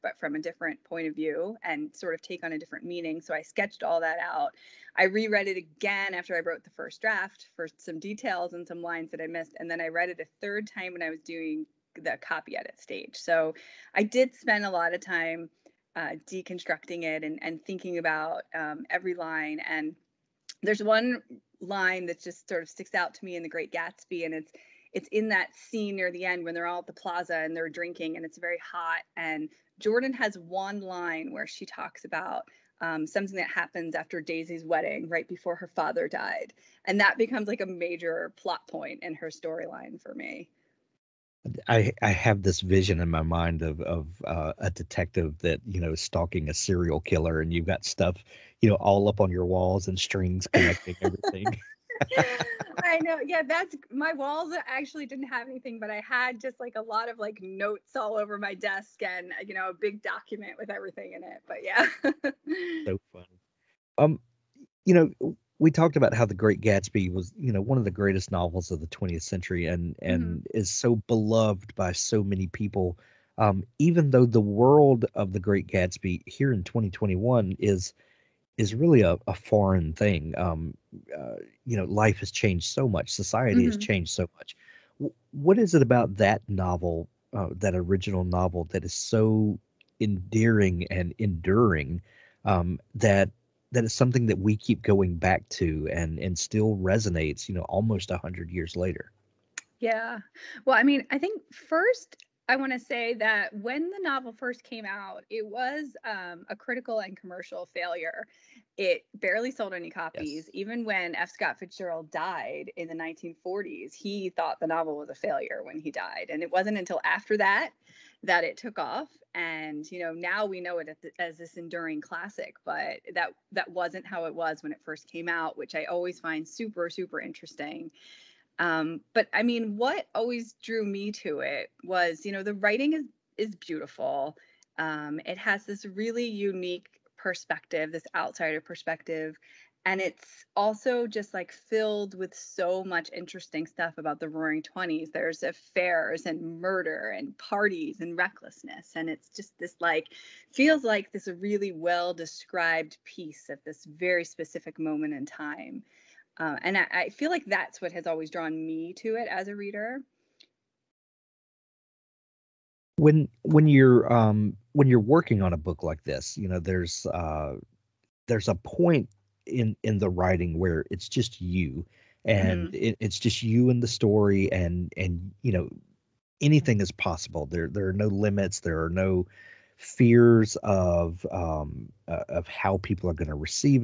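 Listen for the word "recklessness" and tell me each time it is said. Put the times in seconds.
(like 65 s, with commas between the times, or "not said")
148 s.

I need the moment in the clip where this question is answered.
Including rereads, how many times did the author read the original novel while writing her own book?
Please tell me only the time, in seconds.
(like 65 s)
10 s.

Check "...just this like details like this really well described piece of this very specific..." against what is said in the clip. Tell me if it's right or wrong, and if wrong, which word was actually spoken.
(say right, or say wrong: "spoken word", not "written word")
wrong: "feels", not "details".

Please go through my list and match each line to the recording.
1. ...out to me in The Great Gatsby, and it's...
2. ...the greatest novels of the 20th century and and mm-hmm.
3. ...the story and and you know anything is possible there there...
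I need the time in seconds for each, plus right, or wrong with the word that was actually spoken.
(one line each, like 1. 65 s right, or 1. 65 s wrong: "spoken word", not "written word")
1. 22 s right
2. 67 s right
3. 173 s right.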